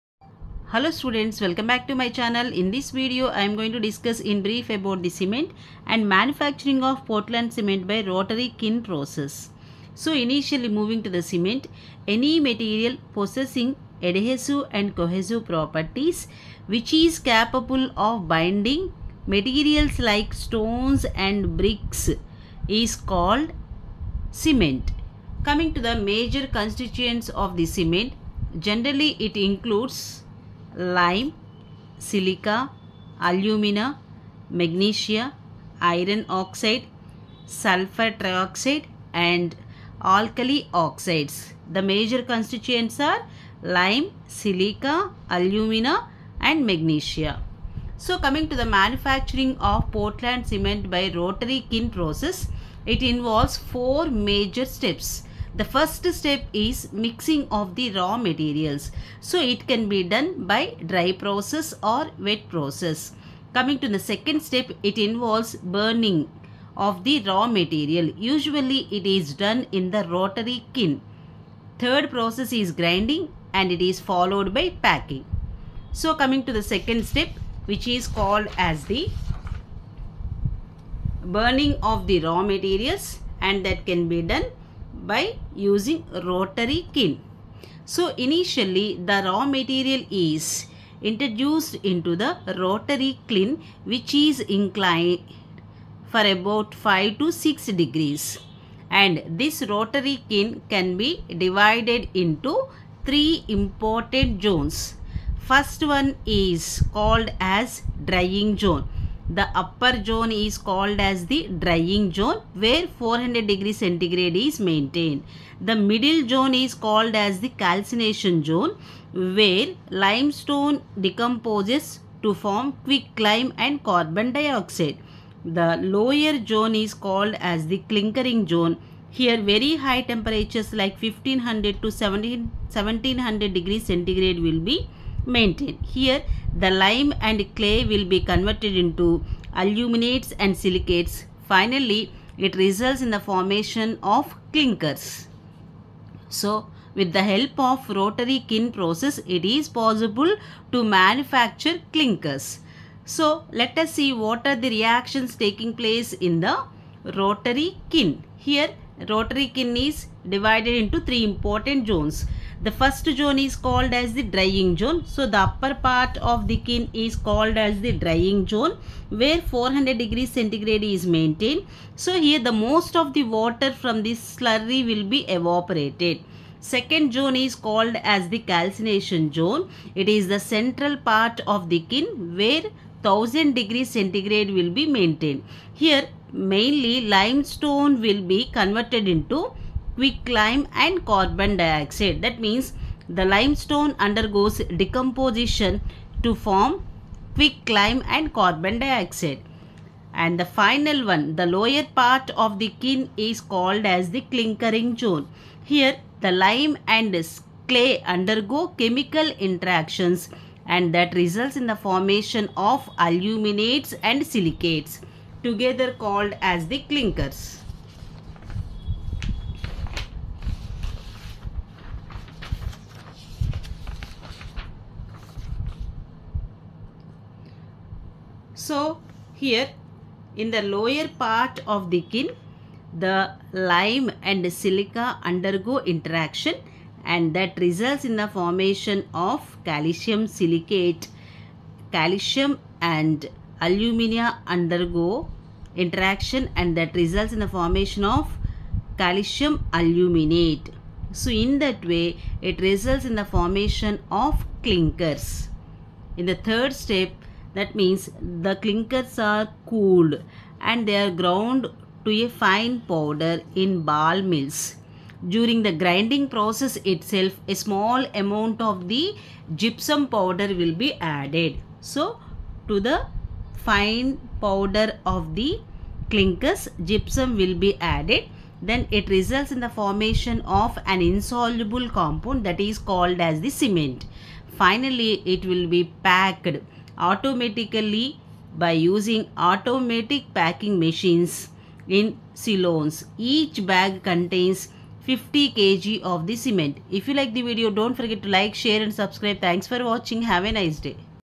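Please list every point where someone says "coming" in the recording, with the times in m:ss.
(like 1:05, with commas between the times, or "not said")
0:25, 0:48, 1:03, 1:16.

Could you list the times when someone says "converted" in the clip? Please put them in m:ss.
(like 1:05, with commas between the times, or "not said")
2:18, 3:08.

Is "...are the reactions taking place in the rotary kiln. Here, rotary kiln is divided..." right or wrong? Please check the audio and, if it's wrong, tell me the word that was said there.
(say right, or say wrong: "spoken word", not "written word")
right.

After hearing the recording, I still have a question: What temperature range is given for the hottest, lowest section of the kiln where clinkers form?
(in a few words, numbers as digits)
1500 to 1700 degrees centigrade.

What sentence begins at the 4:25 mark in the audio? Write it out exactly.
During the grinding process itself, a small amount of the gypsum powder will be added.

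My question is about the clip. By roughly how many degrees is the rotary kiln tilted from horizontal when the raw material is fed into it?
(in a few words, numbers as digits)
5 to 6 degrees.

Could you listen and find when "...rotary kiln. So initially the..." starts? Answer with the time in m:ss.
1:26.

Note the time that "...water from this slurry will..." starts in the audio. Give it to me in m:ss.
2:53.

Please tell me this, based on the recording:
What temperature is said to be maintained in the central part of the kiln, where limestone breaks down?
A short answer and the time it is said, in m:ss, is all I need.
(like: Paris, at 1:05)
1000 degrees centigrade, at 3:03.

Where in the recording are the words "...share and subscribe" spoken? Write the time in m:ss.
4:58.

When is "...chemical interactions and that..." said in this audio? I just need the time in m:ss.
3:28.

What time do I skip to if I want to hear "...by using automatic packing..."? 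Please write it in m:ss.
4:48.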